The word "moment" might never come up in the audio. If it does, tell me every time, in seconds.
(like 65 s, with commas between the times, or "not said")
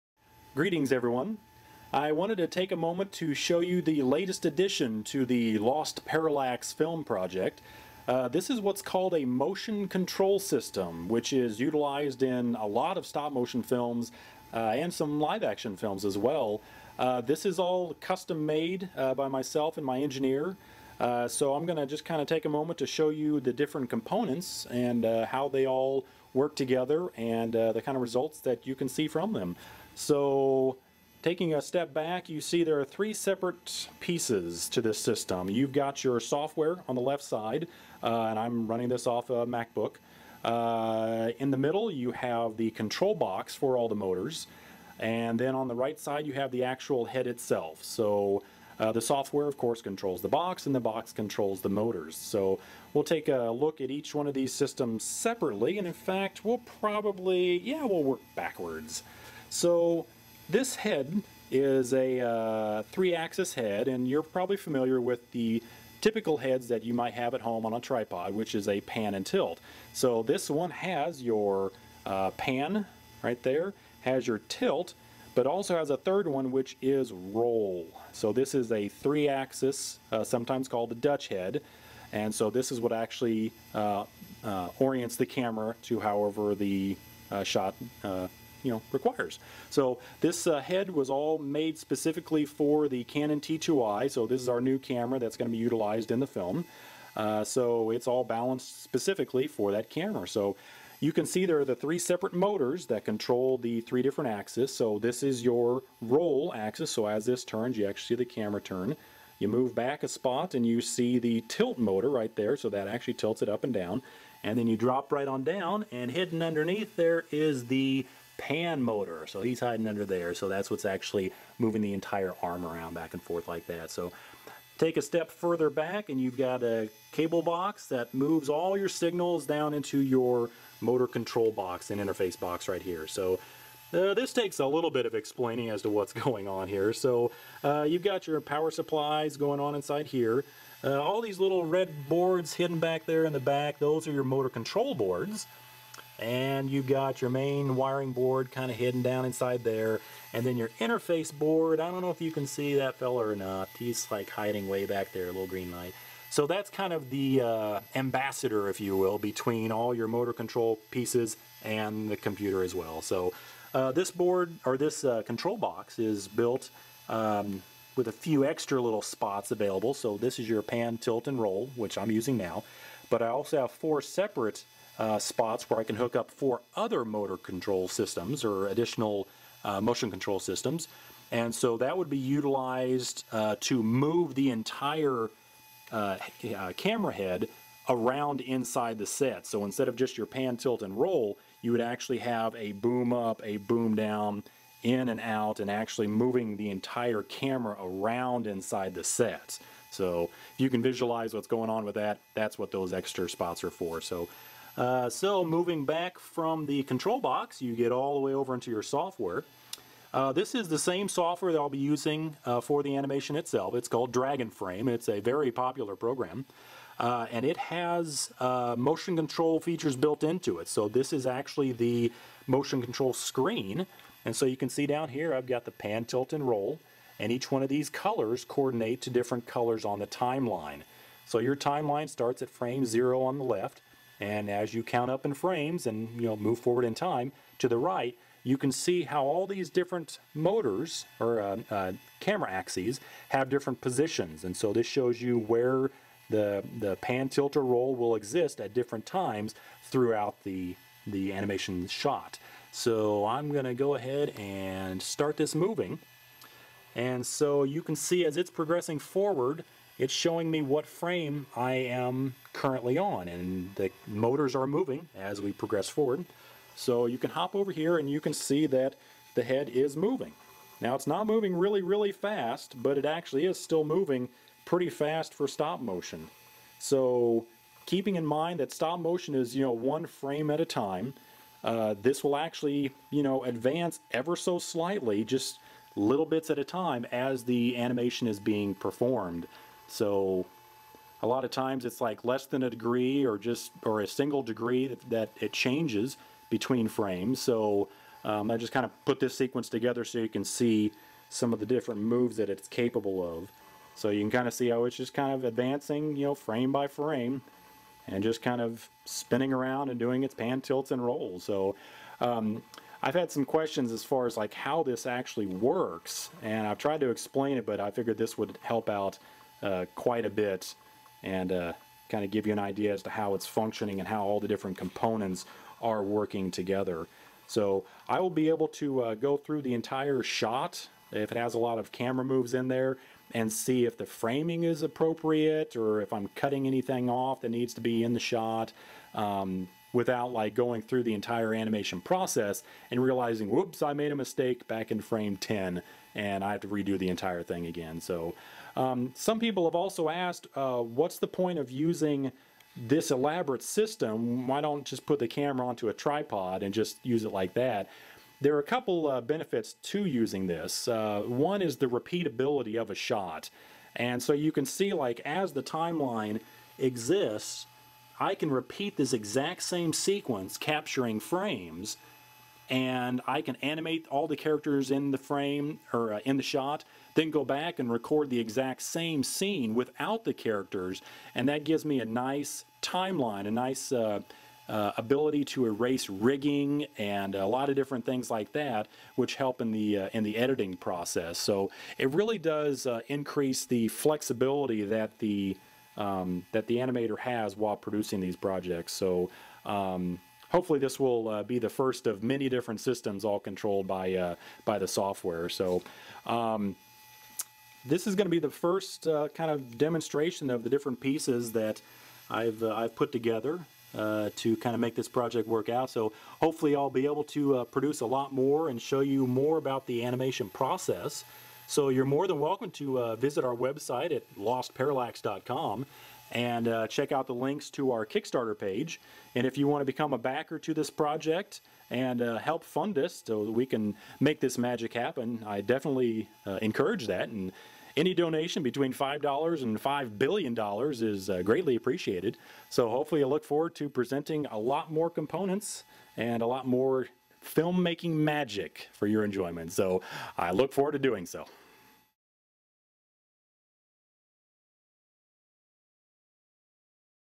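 2 s, 22 s.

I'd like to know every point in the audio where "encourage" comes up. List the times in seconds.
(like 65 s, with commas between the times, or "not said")
436 s.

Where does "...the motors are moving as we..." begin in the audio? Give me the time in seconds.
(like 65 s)
263 s.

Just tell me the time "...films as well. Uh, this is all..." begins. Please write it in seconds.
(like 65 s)
15 s.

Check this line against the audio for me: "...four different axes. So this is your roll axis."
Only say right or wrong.
wrong.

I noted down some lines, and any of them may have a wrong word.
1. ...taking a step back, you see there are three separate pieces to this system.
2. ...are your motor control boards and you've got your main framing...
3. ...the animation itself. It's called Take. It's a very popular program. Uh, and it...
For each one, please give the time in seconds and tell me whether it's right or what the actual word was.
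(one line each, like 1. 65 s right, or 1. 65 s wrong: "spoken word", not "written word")
1. 31 s right
2. 144 s wrong: "wiring", not "framing"
3. 212 s wrong: "Dragonframe", not "Take".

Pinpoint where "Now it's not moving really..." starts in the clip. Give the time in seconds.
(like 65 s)
270 s.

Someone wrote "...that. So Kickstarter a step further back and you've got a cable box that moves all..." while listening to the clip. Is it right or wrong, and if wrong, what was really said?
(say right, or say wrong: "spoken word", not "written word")
wrong: "Take", not "Kickstarter".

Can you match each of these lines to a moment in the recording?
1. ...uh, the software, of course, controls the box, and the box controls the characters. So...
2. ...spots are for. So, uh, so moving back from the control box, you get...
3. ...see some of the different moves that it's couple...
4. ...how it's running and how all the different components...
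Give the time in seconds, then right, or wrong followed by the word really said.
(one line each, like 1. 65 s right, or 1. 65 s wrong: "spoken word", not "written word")
1. 48 s wrong: "motors", not "characters"
2. 203 s right
3. 300 s wrong: "capable", not "couple"
4. 323 s wrong: "functioning", not "running".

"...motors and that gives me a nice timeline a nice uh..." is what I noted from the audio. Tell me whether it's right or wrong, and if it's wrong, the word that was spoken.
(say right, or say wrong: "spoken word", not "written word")
wrong: "characters", not "motors".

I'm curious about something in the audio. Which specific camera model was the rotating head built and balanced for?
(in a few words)
Canon T2i.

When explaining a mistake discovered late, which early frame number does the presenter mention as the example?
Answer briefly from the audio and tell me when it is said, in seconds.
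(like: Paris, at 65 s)
10, at 345 s.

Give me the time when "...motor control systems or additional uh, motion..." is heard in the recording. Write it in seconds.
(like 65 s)
177 s.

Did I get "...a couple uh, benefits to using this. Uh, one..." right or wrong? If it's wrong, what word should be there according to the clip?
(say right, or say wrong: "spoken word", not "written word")
right.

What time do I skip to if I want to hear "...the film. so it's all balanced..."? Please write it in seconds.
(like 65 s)
96 s.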